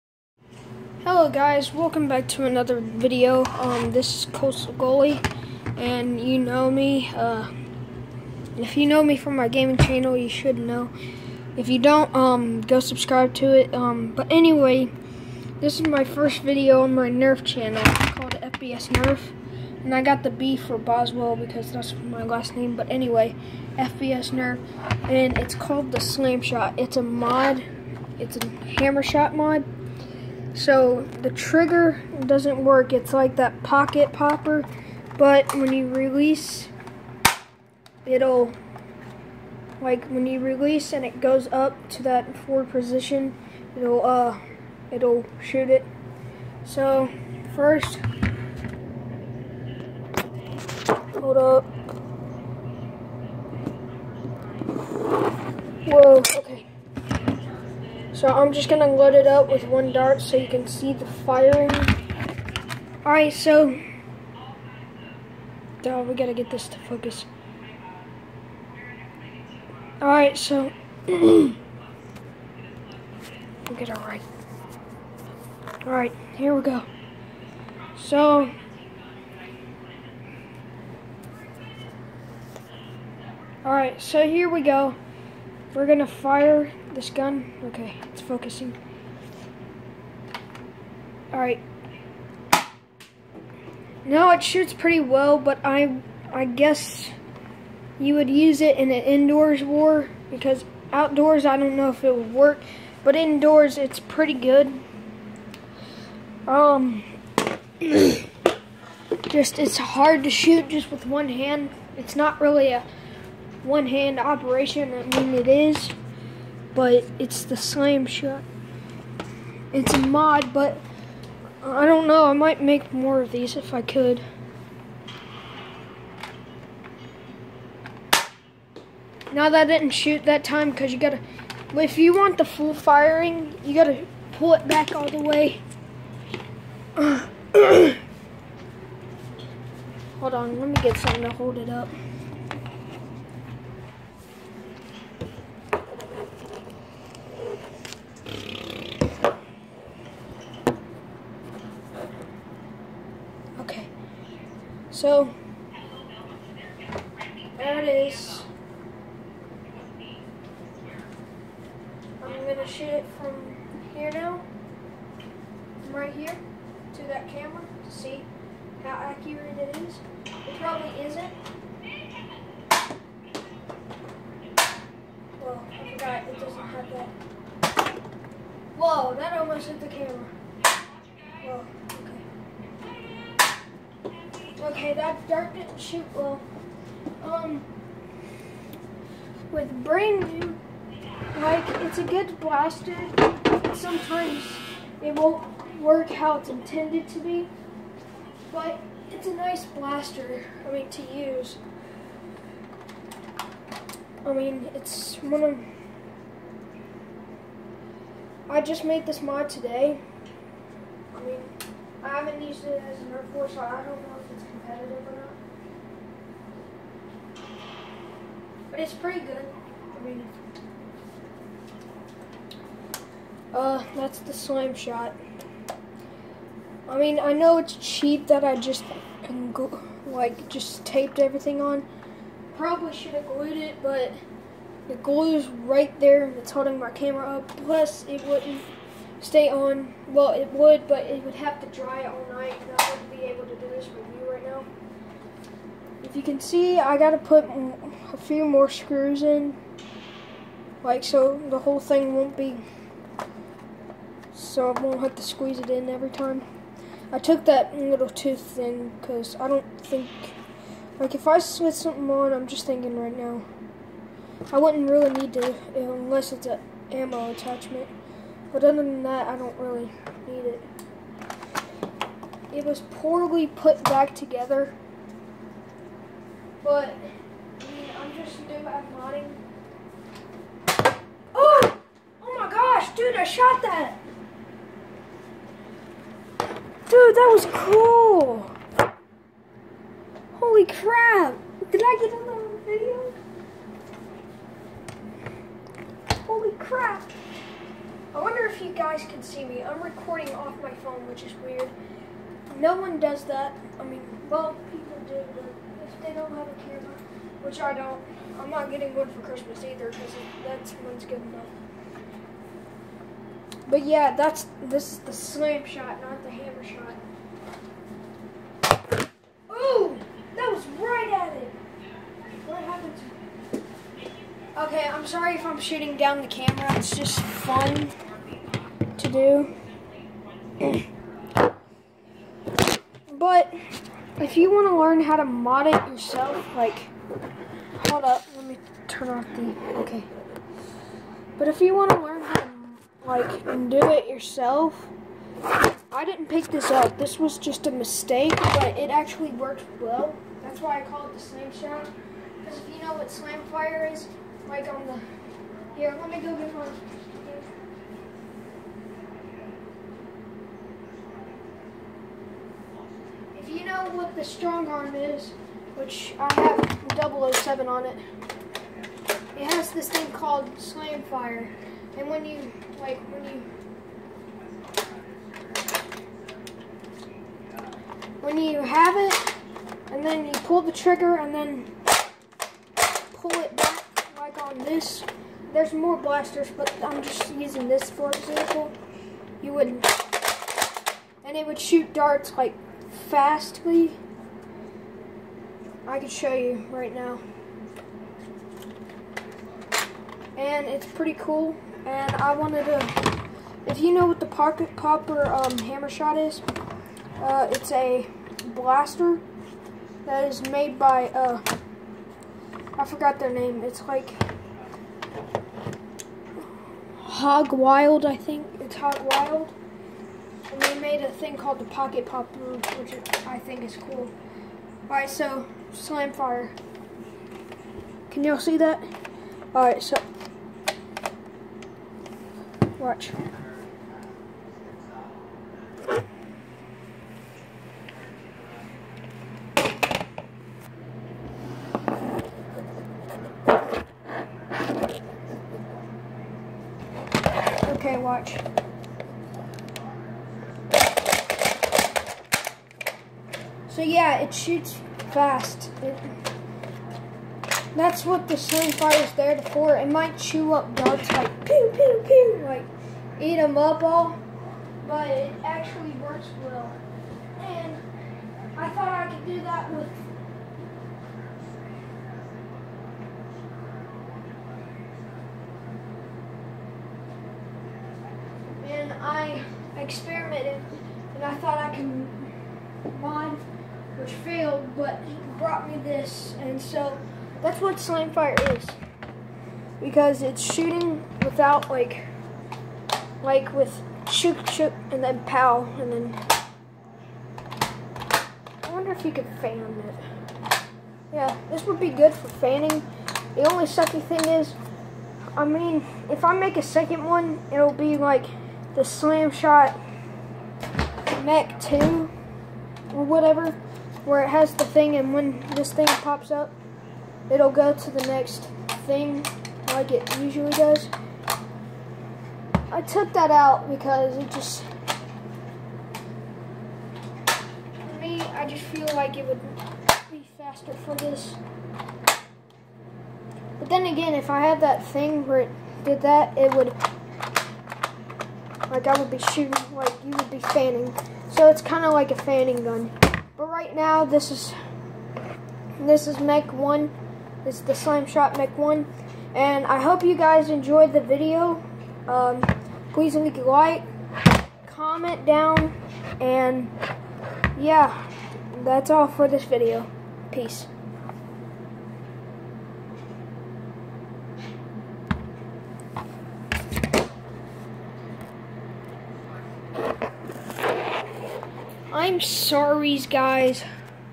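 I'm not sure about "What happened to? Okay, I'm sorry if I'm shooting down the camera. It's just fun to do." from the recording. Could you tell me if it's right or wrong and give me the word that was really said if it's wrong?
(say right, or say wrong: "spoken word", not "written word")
right.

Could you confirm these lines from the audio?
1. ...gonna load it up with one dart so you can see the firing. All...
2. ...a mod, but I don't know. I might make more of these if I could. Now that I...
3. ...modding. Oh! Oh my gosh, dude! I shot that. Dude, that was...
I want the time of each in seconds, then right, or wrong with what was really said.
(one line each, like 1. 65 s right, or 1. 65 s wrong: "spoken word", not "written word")
1. 58 s right
2. 119 s right
3. 278 s right.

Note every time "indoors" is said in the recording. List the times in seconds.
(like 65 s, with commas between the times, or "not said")
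99 s, 103 s.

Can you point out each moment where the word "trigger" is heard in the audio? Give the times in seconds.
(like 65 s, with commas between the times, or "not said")
31 s, 380 s.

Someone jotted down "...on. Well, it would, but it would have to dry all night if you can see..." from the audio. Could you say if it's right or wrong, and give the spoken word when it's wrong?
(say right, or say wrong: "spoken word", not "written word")
right.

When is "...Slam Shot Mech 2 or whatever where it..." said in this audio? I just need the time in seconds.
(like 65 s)
508 s.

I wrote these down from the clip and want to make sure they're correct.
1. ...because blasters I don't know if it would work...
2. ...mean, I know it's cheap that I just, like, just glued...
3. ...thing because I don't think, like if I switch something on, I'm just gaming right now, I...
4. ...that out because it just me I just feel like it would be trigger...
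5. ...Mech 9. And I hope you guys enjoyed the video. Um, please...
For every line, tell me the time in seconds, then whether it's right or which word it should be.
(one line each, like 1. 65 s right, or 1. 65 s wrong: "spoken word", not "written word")
1. 100 s wrong: "outdoors", not "blasters"
2. 226 s wrong: "taped", not "glued"
3. 258 s wrong: "thinking", not "gaming"
4. 523 s wrong: "faster", not "trigger"
5. 548 s wrong: "1", not "9".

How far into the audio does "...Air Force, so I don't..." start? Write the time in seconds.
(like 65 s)
213 s.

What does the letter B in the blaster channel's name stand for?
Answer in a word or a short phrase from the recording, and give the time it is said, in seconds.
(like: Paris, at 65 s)
Boswell, at 20 s.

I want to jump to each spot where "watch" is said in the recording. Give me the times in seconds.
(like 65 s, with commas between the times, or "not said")
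432 s, 447 s.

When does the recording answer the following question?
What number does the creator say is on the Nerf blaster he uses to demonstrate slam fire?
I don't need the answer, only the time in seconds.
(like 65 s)
367 s.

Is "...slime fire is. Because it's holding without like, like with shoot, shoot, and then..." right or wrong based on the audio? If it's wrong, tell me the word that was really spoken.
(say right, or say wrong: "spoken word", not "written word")
wrong: "shooting", not "holding".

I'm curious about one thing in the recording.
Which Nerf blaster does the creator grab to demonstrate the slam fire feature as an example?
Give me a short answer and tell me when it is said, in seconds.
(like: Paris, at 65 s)
Strongarm, at 364 s.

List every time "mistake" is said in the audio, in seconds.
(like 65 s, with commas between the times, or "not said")
347 s.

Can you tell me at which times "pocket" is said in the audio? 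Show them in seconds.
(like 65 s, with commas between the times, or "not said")
33 s, 404 s, 421 s.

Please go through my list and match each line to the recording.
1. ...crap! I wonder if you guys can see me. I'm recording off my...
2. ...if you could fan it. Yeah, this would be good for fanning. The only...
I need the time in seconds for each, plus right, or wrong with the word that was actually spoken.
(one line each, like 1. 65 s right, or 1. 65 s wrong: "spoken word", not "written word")
1. 296 s right
2. 498 s right.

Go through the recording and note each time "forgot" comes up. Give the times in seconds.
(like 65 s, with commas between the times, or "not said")
175 s, 412 s.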